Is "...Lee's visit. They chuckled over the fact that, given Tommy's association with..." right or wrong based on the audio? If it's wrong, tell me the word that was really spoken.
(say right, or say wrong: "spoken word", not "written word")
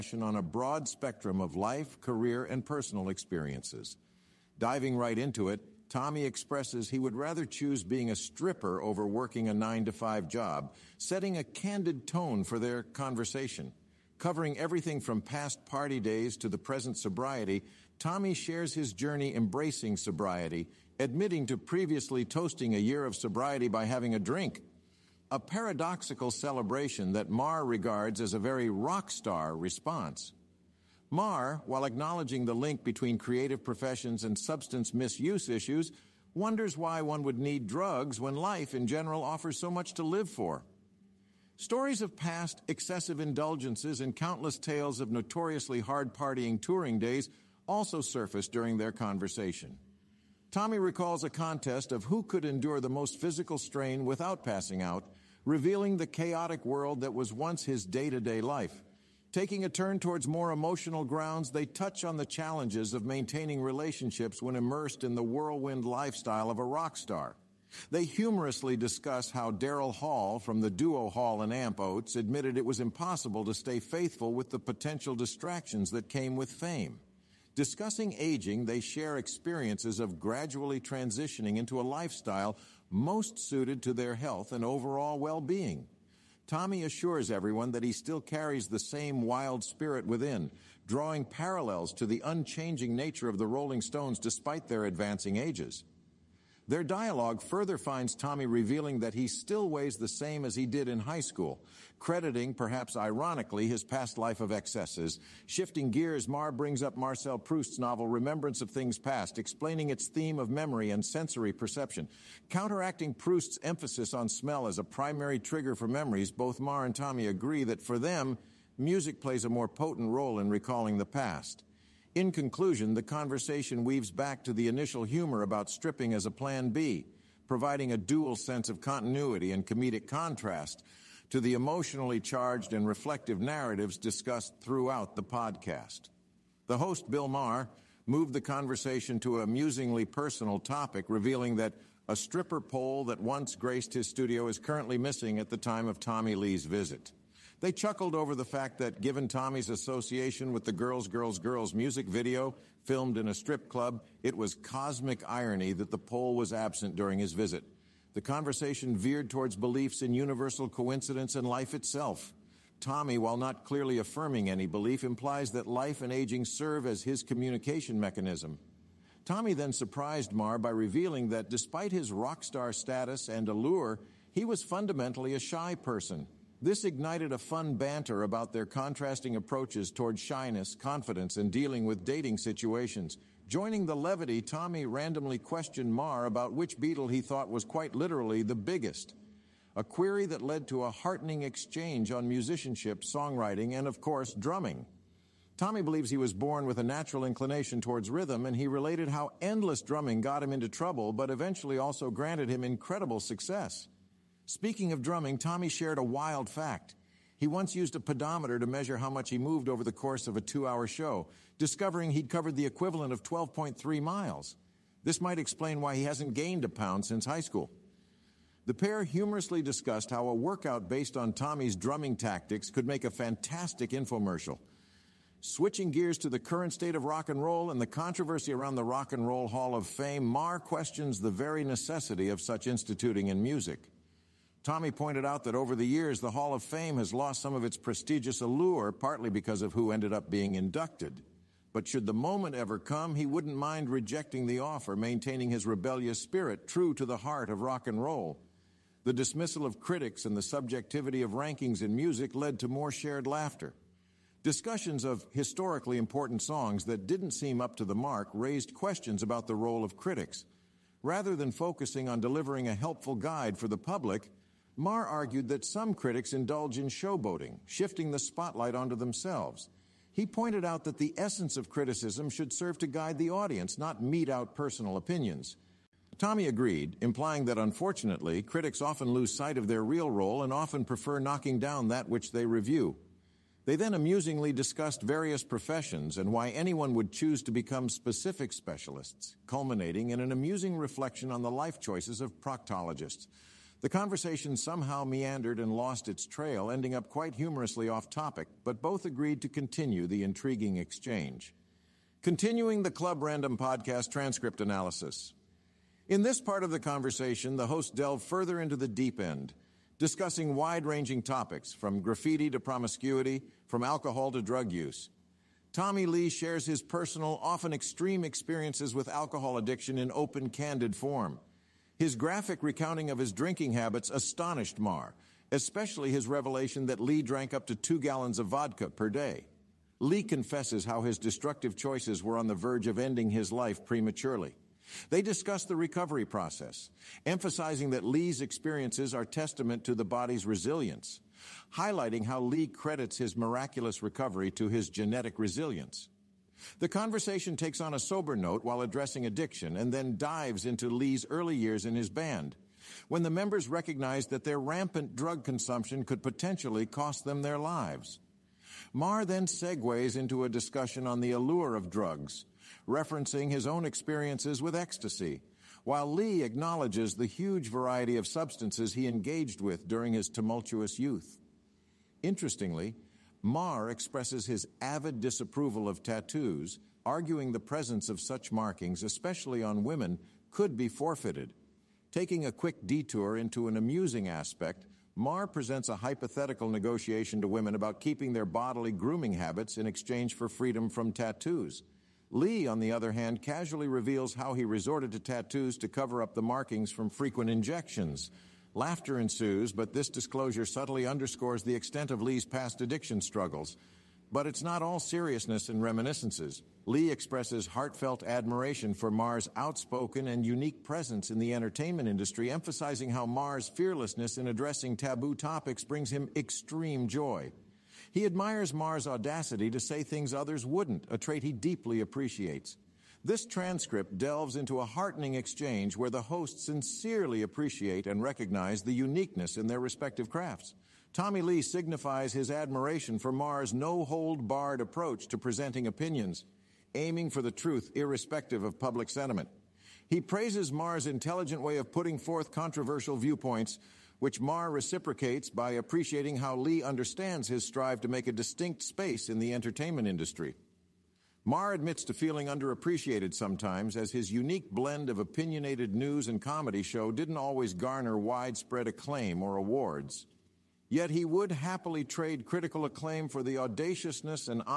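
right.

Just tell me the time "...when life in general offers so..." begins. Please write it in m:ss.
0:38.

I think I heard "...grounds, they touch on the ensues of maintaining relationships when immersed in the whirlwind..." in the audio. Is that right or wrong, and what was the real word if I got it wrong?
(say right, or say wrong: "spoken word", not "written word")
wrong: "challenges", not "ensues".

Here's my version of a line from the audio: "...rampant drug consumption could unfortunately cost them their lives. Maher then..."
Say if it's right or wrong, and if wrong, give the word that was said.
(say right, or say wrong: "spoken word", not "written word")
wrong: "potentially", not "unfortunately".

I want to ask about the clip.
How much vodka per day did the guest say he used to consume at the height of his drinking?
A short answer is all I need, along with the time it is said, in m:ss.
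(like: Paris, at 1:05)
2 gallons, at 5:27.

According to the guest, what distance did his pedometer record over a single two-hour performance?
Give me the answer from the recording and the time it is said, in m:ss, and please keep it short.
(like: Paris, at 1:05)
12.3 miles, at 3:33.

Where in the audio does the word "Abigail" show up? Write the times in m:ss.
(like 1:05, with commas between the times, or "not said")
not said.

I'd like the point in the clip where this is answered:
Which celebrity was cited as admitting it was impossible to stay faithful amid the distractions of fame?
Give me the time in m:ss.
1:09.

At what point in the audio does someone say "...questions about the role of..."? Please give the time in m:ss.
4:18.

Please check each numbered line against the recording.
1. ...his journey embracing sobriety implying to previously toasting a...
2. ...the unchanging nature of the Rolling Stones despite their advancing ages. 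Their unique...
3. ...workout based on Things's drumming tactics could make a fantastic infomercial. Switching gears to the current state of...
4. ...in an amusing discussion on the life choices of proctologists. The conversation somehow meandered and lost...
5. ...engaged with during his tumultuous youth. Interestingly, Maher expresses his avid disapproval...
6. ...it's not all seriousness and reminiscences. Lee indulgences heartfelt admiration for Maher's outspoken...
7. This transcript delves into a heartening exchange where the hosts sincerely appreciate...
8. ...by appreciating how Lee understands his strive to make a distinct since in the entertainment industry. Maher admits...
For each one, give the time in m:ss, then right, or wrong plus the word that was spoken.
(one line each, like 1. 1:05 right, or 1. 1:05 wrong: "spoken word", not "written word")
1. 0:18 wrong: "admitting", not "implying"
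2. 1:32 wrong: "dialogue", not "unique"
3. 3:40 wrong: "Tommy", not "Things"
4. 4:50 wrong: "reflection", not "discussion"
5. 6:09 right
6. 6:44 wrong: "expresses", not "indulgences"
7. 7:03 right
8. 7:25 wrong: "space", not "since".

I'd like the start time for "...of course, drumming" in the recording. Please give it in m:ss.
3:13.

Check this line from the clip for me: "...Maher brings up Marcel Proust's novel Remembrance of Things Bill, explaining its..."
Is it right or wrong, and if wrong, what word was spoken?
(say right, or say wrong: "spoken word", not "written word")
wrong: "Past", not "Bill".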